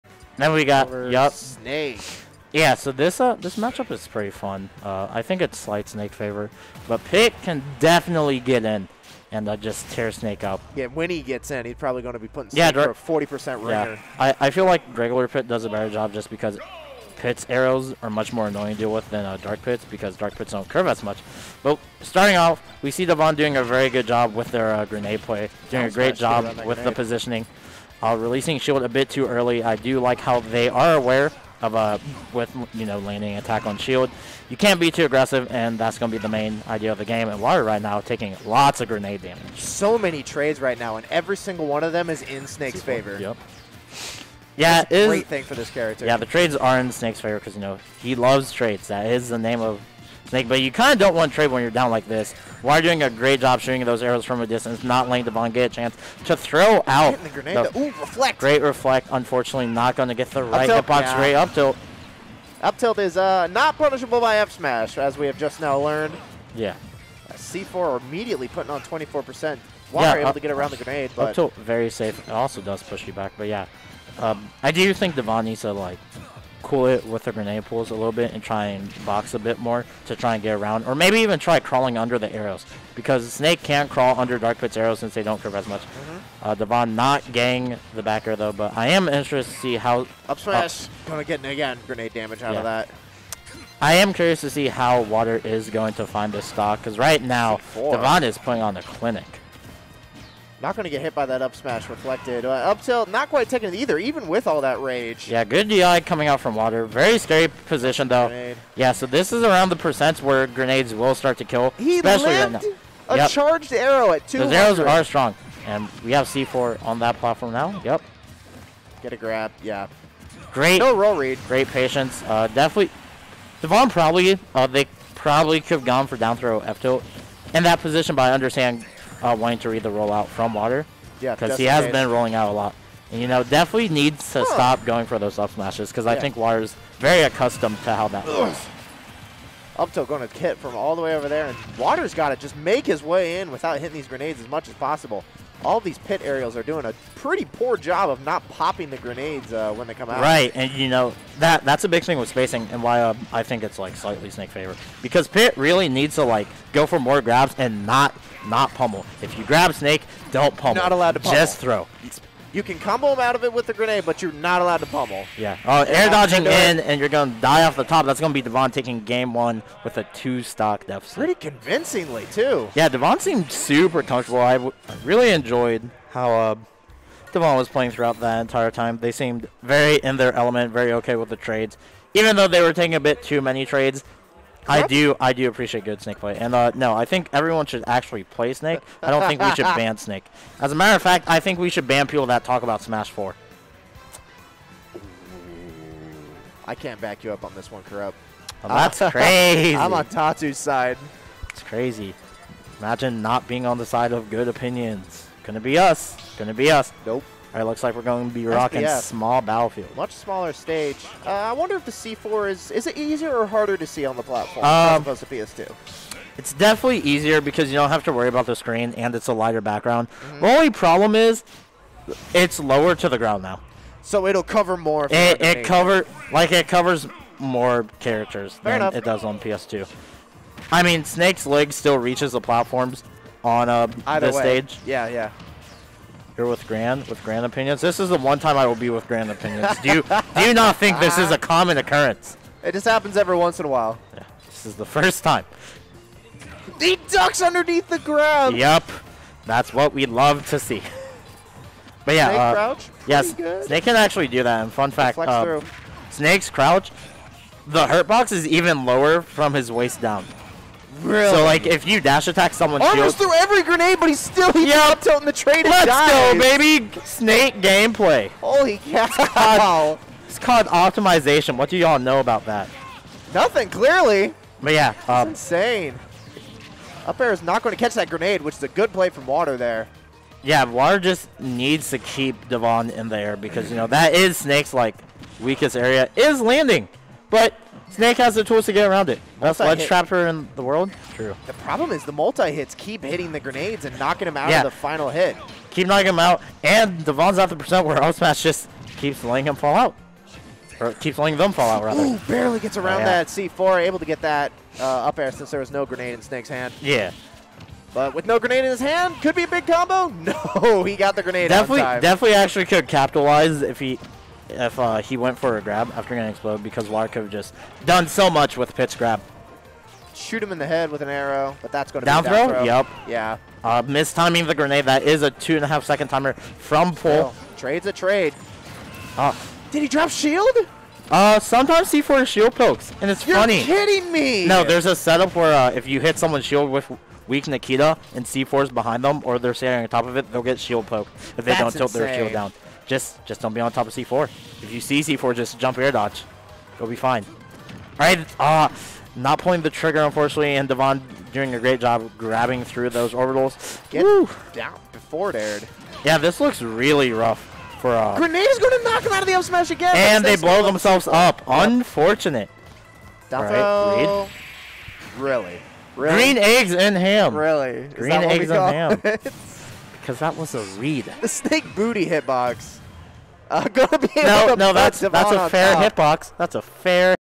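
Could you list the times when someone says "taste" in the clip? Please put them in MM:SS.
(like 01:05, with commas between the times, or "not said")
not said.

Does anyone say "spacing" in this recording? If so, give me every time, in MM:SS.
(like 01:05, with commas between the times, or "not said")
02:32.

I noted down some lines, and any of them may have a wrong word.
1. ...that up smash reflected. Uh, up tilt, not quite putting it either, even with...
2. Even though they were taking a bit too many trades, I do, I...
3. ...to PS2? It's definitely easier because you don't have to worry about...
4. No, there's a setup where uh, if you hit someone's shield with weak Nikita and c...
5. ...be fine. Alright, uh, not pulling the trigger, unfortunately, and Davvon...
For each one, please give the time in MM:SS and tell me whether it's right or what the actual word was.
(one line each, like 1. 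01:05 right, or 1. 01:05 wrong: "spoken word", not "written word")
1. 01:41 wrong: "taking", not "putting"
2. 03:02 right
3. 03:35 right
4. 05:34 right
5. 05:46 right.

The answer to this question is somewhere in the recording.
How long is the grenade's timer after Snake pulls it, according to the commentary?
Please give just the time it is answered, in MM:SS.
05:25.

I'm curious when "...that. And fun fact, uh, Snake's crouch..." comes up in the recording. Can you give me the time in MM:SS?
04:14.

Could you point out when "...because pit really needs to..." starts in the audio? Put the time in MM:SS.
02:35.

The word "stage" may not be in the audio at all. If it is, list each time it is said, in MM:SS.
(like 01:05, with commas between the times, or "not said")
03:30, 03:54.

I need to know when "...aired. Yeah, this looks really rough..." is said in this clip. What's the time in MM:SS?
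05:55.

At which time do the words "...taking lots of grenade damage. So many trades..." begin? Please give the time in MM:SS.
00:38.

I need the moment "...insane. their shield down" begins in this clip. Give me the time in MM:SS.
05:41.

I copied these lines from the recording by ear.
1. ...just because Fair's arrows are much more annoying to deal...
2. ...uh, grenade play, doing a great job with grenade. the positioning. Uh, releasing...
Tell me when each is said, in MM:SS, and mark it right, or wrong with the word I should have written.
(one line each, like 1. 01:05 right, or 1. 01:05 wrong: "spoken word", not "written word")
1. 00:16 wrong: "Pit", not "Fair"
2. 00:24 right.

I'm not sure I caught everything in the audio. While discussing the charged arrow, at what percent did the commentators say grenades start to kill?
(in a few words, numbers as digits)
200.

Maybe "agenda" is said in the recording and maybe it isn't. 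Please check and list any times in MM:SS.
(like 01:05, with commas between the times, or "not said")
not said.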